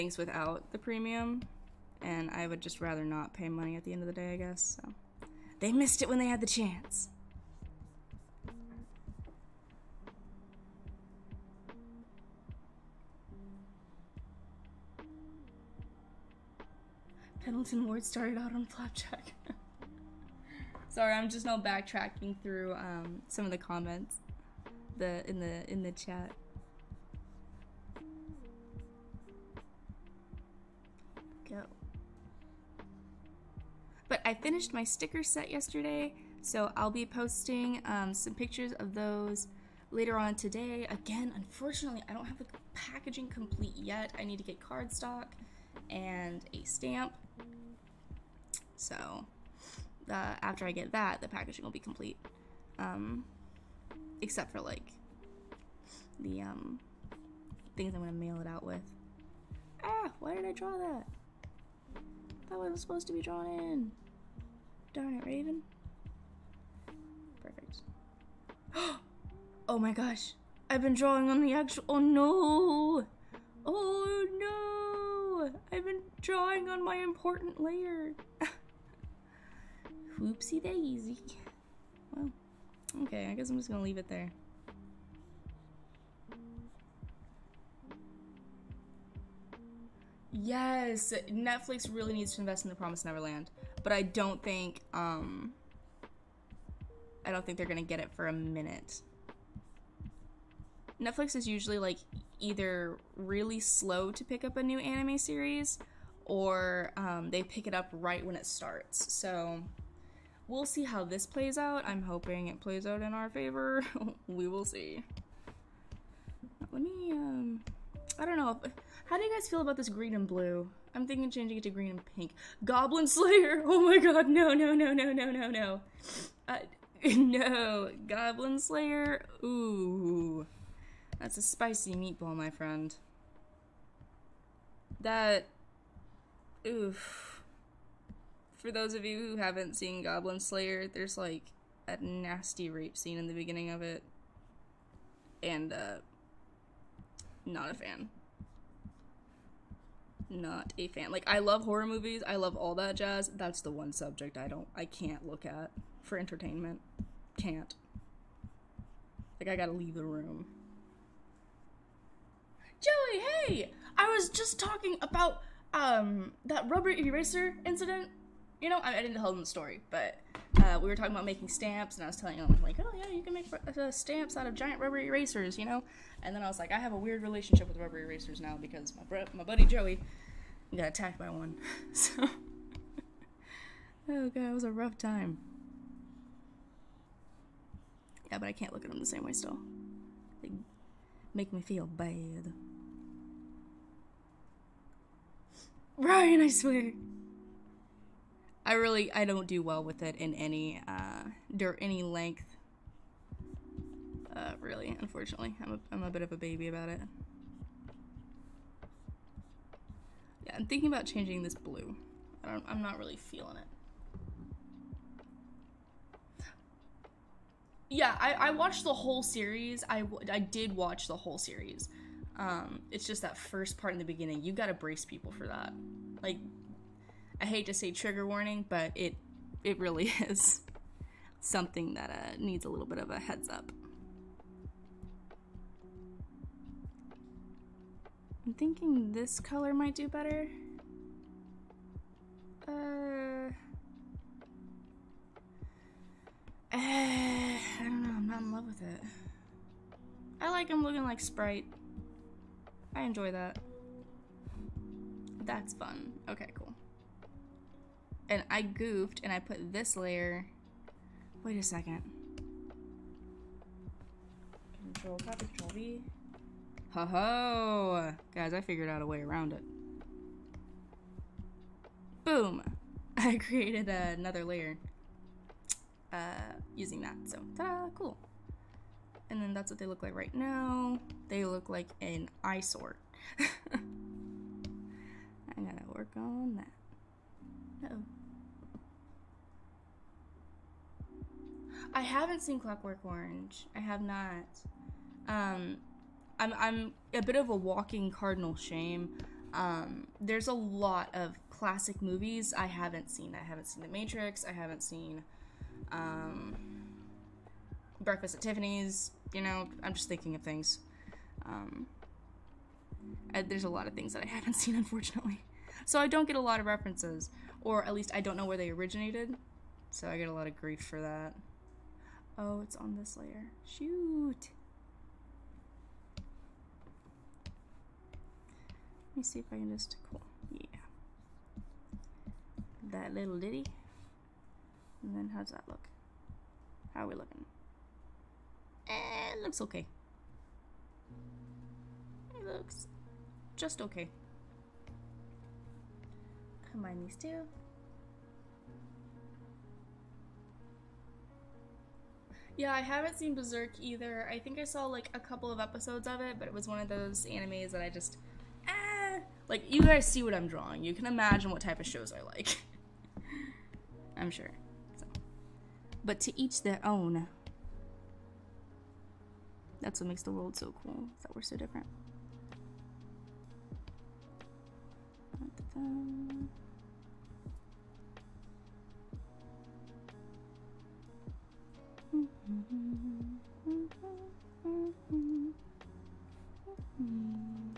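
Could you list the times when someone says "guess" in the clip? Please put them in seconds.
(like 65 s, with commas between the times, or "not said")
4 s, 83 s.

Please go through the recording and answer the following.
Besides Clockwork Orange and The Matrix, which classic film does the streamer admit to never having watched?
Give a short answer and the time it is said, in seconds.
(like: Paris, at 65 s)
Breakfast at Tiffany's, at 307 s.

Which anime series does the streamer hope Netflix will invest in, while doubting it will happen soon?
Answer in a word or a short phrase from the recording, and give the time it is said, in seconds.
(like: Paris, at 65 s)
The Promised Neverland, at 92 s.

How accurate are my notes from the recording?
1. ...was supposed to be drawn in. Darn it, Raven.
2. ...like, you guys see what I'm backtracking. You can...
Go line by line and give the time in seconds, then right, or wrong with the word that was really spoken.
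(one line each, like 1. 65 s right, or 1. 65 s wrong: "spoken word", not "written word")
1. 62 s right
2. 359 s wrong: "drawing", not "backtracking".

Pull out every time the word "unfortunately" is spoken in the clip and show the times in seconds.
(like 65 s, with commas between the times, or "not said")
41 s, 204 s, 314 s.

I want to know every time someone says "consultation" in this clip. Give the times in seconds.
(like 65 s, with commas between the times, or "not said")
not said.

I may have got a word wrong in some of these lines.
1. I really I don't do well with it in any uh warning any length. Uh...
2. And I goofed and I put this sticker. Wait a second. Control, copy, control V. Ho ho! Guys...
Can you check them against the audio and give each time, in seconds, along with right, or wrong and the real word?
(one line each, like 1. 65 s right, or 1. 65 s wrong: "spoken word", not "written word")
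1. 198 s wrong: "during", not "warning"
2. 258 s wrong: "layer", not "sticker".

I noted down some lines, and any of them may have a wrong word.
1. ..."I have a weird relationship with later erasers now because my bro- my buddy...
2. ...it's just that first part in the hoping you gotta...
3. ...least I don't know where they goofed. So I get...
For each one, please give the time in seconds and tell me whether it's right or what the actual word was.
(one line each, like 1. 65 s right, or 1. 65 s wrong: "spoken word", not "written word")
1. 176 s wrong: "rubber", not "later"
2. 222 s wrong: "beginning", not "hoping"
3. 317 s wrong: "originated", not "goofed".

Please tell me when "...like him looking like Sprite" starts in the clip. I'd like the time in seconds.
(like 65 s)
250 s.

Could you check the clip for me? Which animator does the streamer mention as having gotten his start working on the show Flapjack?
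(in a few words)
Pendleton Ward.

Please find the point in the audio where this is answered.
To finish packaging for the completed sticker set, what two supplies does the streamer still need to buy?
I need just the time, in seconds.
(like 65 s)
44 s.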